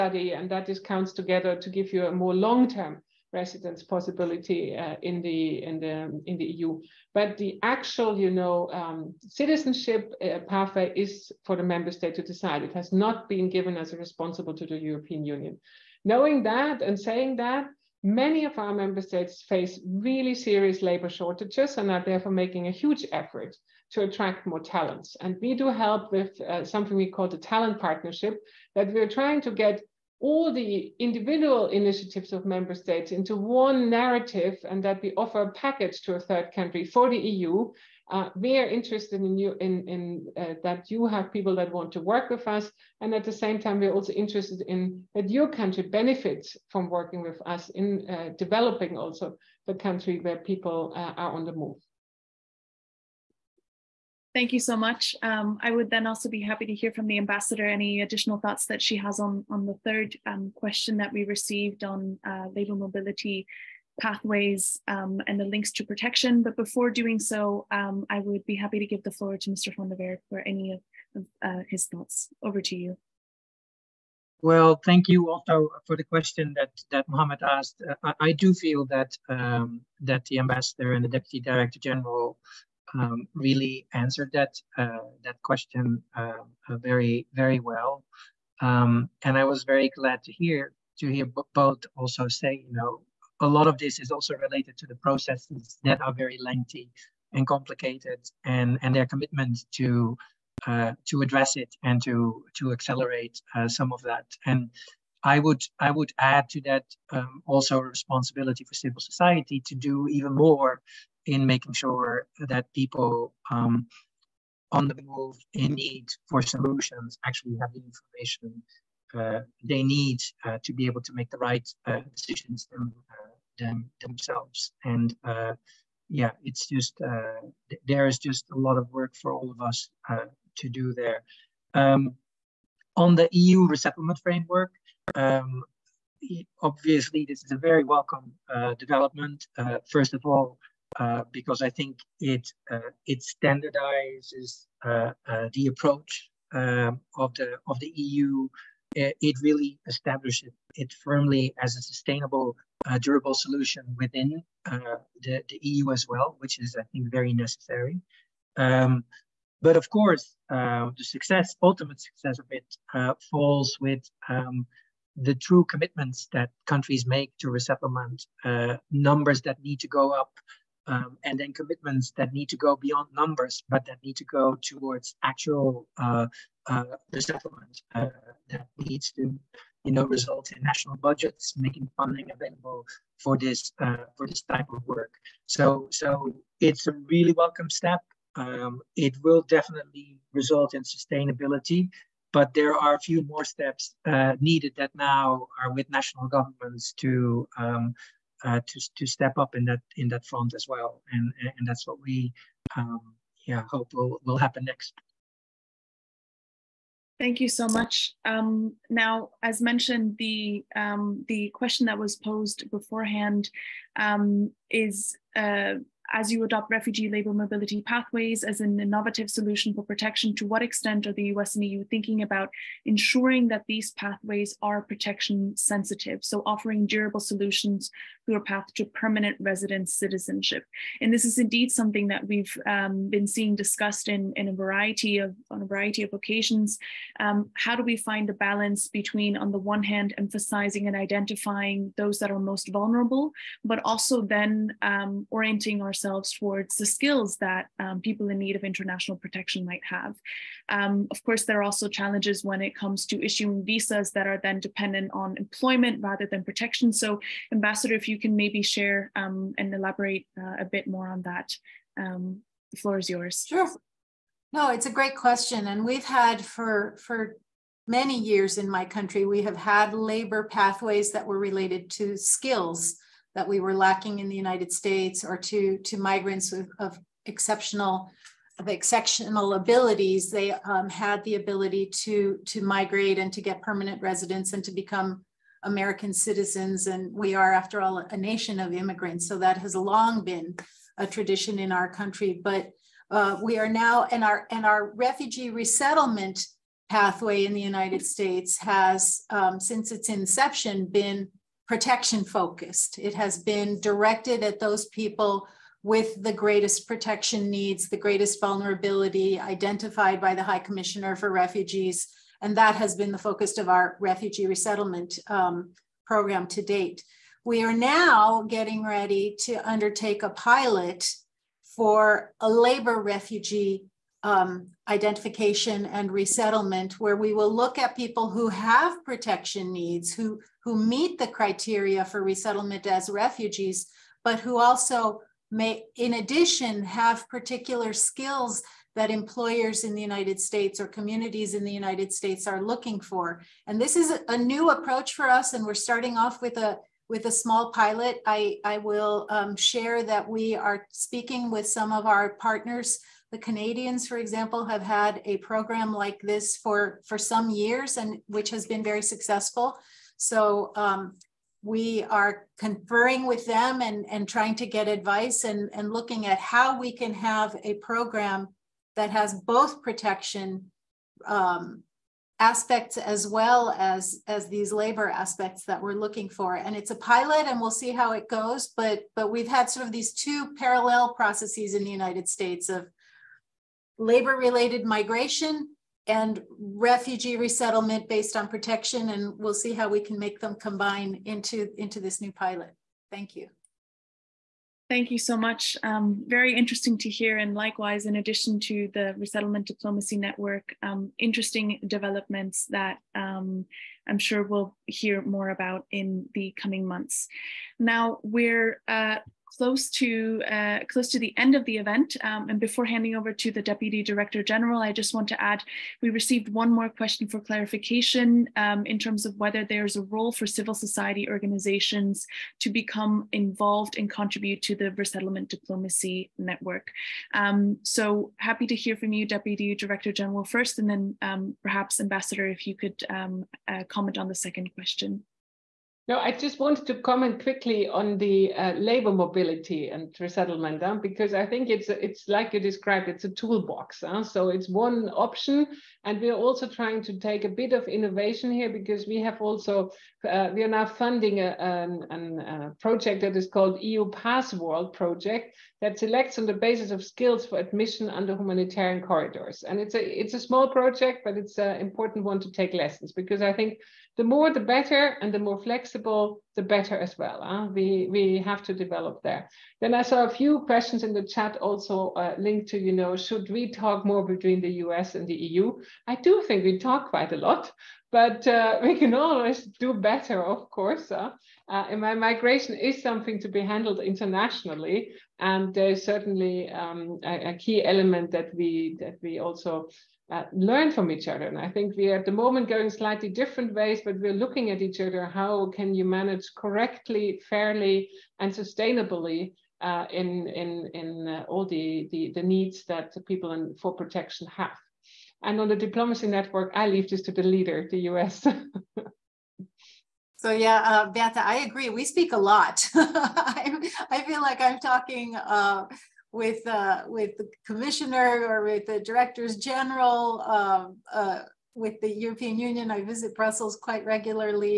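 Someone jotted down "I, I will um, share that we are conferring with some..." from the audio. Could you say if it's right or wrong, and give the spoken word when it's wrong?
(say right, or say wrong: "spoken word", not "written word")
wrong: "speaking", not "conferring".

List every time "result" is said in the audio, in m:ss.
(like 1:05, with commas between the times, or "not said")
3:00, 3:10.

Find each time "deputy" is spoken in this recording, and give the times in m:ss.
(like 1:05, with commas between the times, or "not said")
1:21, 6:53, 7:09.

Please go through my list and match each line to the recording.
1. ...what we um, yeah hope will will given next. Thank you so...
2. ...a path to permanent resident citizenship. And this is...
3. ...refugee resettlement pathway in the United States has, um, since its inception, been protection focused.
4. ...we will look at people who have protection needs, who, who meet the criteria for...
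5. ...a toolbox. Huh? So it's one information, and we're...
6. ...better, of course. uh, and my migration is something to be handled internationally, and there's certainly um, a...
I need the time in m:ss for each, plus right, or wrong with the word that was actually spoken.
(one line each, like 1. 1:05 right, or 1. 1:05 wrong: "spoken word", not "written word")
1. 3:21 wrong: "happen", not "given"
2. 3:48 right
3. 4:54 right
4. 5:27 right
5. 7:23 wrong: "option", not "information"
6. 7:59 right.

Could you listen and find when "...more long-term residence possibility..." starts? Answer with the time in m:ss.
0:02.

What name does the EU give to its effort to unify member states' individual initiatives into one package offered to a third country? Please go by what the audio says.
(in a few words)
talent partnership.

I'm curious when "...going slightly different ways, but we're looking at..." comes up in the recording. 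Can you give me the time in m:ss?
8:12.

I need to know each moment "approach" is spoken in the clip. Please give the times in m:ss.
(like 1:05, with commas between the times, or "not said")
2:25, 5:44.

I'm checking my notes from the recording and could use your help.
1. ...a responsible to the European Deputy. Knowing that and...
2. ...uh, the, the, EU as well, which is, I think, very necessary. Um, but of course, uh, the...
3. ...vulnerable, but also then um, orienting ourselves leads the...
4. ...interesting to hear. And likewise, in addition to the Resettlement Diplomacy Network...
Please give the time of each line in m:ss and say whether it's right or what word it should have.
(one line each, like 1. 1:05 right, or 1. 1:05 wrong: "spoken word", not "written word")
1. 0:13 wrong: "Union", not "Deputy"
2. 2:34 right
3. 4:02 wrong: "towards", not "leads"
4. 6:36 right.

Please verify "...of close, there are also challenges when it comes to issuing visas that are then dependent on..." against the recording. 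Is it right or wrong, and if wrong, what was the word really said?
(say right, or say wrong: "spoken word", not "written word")
wrong: "course", not "close".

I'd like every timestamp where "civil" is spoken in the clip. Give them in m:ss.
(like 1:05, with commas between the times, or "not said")
1:48, 7:00.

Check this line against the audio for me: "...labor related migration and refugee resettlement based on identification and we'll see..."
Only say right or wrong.
wrong.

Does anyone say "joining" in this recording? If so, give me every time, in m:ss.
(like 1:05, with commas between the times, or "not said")
not said.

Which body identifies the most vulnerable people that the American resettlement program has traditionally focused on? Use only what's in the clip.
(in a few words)
High Commissioner for Refugees.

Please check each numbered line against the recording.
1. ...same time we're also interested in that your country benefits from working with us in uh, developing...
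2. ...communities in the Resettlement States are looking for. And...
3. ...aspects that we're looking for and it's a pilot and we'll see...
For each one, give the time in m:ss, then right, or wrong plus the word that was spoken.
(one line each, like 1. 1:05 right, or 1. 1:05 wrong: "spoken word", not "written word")
1. 0:43 right
2. 5:40 wrong: "United", not "Resettlement"
3. 6:15 right.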